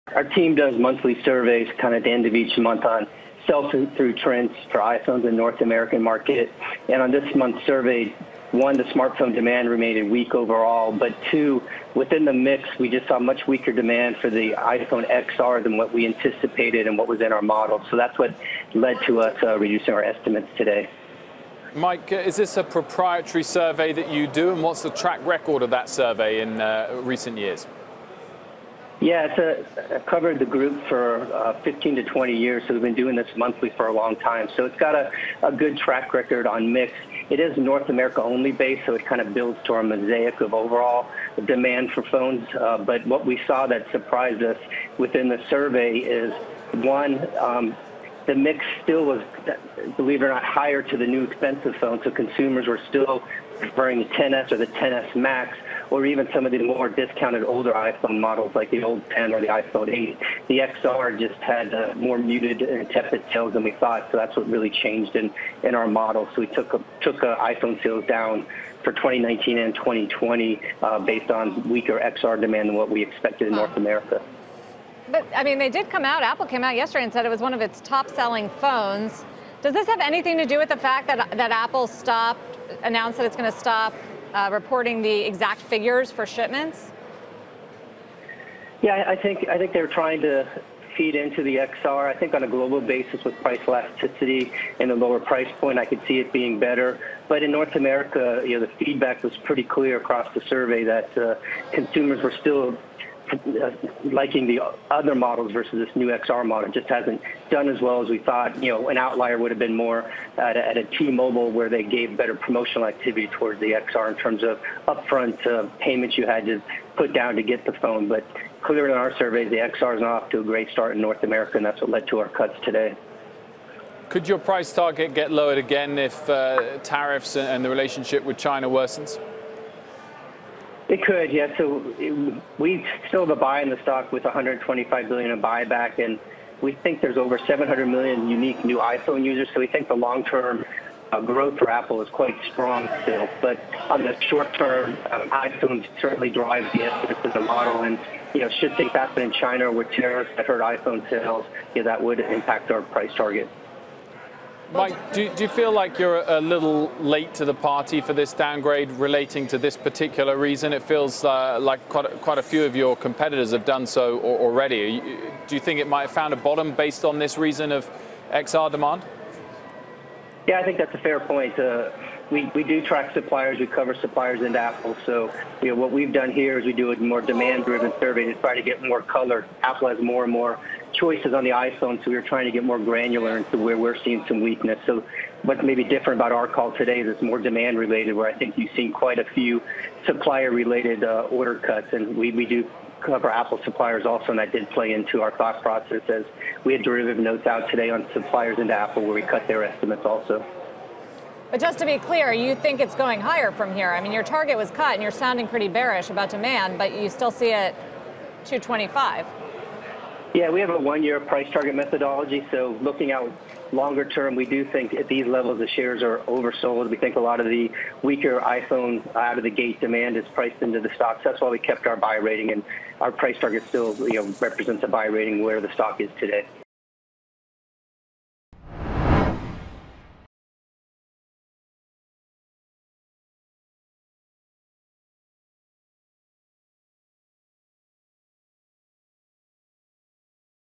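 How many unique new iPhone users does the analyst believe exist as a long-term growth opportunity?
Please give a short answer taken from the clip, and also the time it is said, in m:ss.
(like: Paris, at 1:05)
over 700 million, at 2:17.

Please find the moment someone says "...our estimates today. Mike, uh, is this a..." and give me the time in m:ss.
0:19.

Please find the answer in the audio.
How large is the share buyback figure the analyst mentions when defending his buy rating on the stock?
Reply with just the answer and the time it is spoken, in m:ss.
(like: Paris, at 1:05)
$125 billion, at 2:14.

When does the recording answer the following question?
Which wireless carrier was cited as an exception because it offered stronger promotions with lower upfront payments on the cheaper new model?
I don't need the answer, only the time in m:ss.
1:50.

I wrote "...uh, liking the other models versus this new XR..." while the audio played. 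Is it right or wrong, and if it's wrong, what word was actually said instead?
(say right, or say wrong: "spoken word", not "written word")
right.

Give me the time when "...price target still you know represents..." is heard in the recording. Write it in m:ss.
3:43.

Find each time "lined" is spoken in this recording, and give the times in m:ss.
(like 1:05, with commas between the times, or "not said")
not said.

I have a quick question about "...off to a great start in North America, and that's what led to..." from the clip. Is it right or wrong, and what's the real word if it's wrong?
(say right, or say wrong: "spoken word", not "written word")
right.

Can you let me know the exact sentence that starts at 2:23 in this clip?
But on the short term, um, iPhone certainly drives the essence of the model.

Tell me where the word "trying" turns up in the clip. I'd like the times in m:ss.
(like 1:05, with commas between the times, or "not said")
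1:29, 3:02.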